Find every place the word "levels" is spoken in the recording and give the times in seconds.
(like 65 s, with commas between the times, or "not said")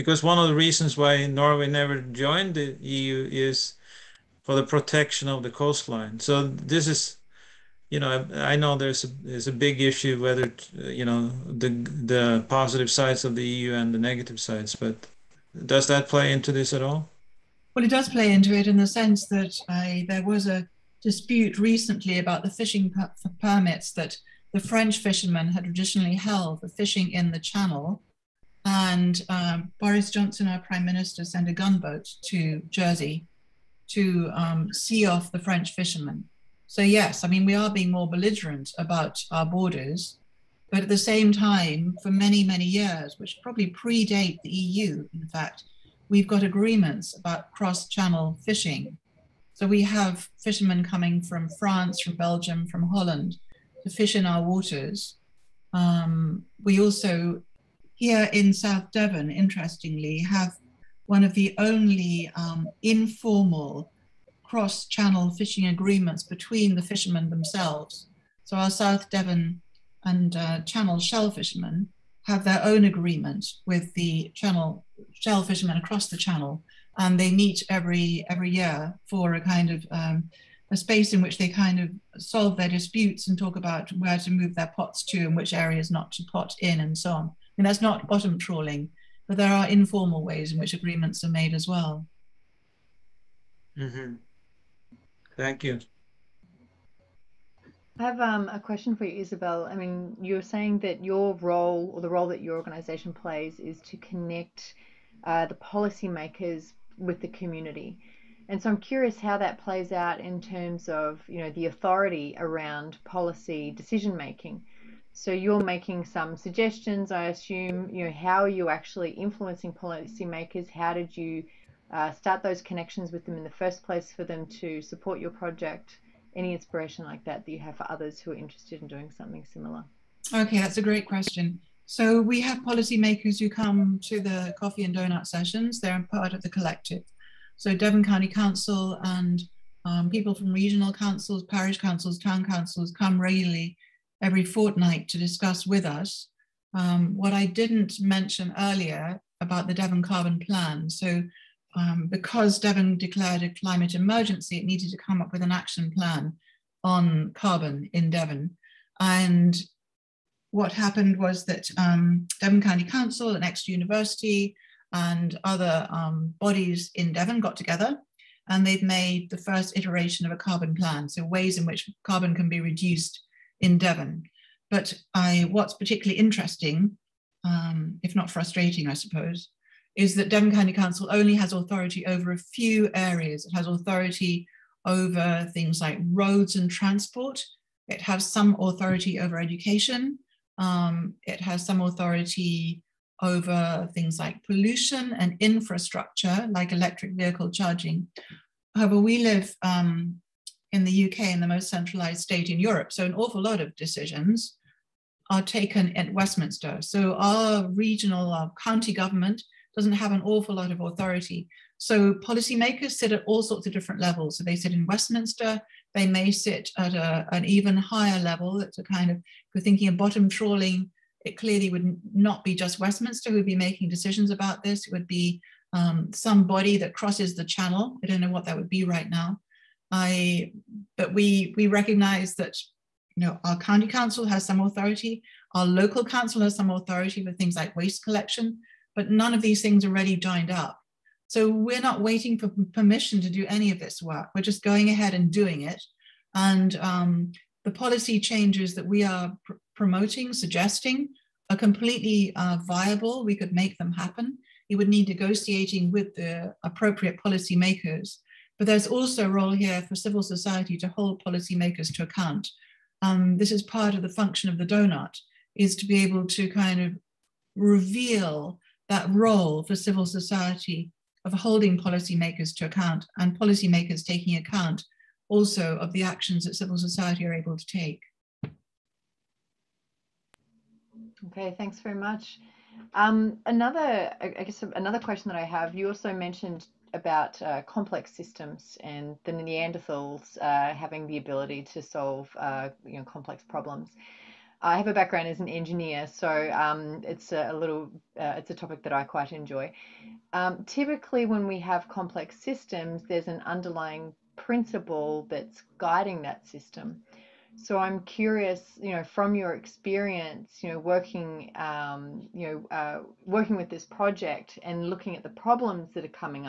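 214 s, 218 s.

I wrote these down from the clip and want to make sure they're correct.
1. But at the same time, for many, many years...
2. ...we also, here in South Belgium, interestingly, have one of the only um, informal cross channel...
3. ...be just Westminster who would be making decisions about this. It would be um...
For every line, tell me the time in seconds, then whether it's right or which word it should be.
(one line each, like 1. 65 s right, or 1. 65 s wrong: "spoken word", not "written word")
1. 40 s right
2. 56 s wrong: "Devon", not "Belgium"
3. 222 s right.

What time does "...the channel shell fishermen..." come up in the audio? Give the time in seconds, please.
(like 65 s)
73 s.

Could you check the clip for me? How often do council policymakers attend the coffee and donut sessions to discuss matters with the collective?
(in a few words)
Every fortnight.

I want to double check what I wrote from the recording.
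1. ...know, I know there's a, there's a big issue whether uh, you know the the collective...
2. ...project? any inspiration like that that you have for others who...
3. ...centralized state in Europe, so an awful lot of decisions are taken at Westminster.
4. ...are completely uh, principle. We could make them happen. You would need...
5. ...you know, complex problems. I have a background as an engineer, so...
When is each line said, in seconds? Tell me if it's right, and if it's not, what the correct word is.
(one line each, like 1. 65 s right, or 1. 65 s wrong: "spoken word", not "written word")
1. 7 s wrong: "positive", not "collective"
2. 125 s right
3. 201 s right
4. 251 s wrong: "viable", not "principle"
5. 292 s right.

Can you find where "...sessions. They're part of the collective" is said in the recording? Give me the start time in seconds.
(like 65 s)
135 s.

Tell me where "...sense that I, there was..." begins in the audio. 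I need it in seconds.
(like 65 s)
18 s.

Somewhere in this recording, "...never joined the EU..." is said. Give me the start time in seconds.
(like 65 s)
1 s.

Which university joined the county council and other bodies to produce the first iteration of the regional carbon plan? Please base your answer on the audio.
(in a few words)
Exeter University.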